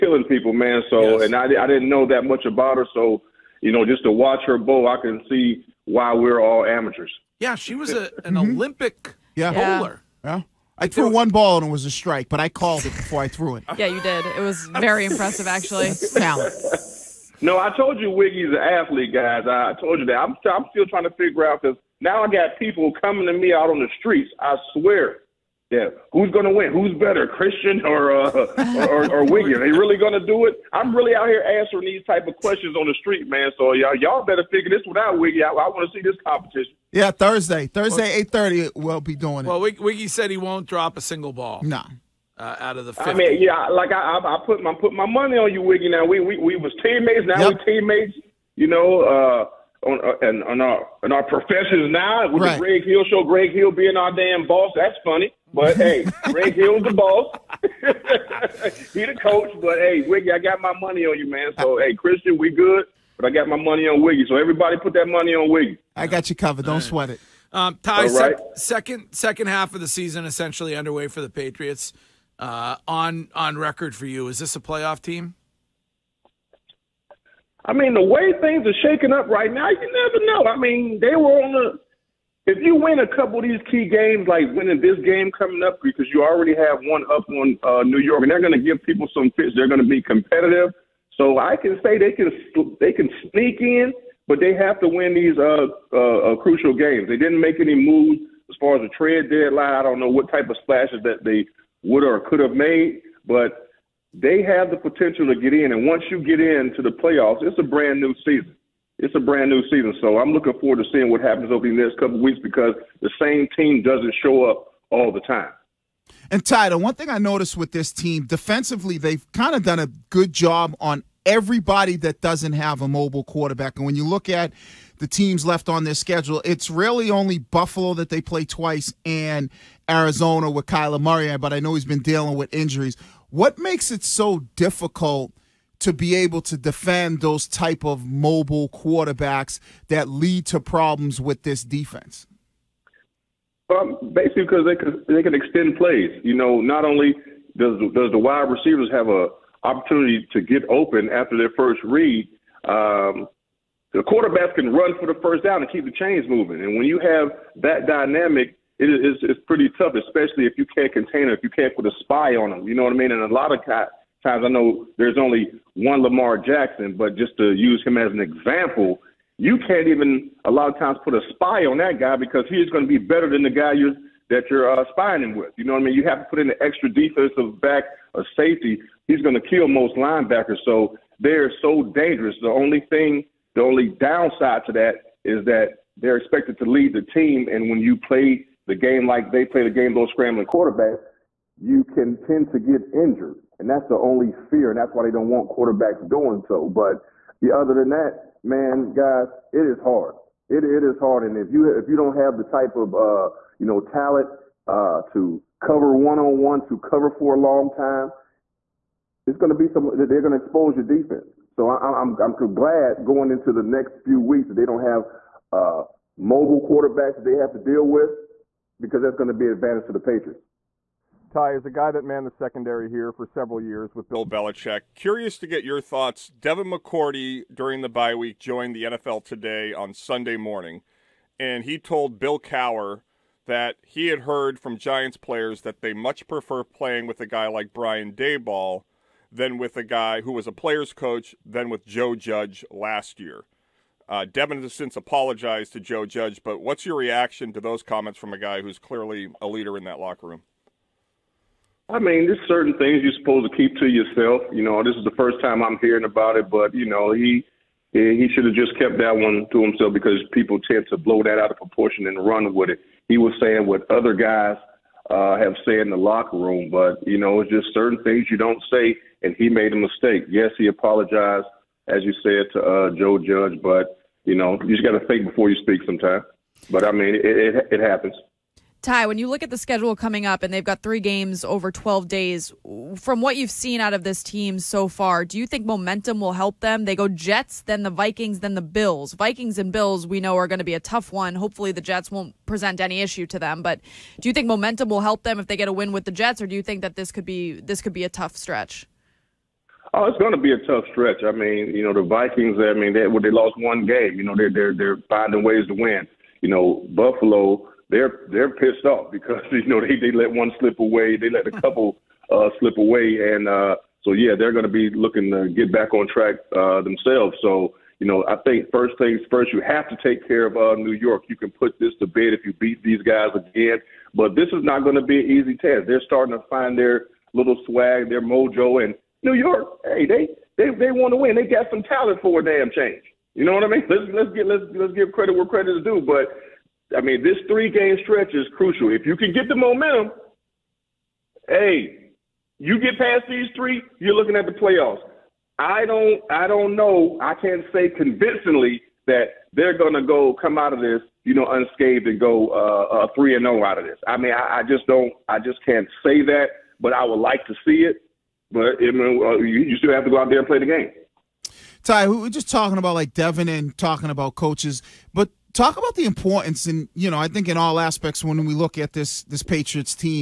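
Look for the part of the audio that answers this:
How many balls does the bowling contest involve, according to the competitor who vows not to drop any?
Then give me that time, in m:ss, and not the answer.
0:42.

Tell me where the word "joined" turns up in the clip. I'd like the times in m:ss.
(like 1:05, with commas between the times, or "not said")
3:48.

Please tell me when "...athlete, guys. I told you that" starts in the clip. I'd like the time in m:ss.
0:18.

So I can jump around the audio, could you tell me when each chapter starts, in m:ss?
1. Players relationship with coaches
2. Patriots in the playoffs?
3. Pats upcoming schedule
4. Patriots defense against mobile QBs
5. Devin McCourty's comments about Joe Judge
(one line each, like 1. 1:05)
1. 6:01
2. 1:07
3. 4:38
4. 1:56
5. 3:40.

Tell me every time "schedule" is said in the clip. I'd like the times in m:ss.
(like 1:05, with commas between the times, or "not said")
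2:05, 4:39.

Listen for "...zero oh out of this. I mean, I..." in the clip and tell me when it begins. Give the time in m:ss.
5:53.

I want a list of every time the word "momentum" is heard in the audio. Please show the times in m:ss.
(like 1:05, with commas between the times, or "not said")
4:45, 4:54, 5:39.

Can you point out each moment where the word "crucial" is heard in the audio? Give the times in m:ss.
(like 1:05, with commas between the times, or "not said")
1:36, 5:38.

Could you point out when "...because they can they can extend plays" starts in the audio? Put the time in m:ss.
2:24.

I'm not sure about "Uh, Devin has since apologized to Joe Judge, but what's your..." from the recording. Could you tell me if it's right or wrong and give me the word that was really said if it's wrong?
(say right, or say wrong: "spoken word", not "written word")
right.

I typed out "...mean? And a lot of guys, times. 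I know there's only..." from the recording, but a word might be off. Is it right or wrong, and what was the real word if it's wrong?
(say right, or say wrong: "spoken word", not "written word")
right.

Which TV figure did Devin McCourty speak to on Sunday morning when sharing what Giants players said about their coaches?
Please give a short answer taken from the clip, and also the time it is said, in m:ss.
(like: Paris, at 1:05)
Bill Cowher, at 3:52.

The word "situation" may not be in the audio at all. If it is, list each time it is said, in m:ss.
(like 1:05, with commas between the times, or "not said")
not said.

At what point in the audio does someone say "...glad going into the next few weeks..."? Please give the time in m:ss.
3:32.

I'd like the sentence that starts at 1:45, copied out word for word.
And once you get into the playoffs, it's a brand new season it's a brand new season.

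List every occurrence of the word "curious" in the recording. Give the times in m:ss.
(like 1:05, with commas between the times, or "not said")
3:44.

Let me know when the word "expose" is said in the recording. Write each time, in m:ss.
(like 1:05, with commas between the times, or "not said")
3:30.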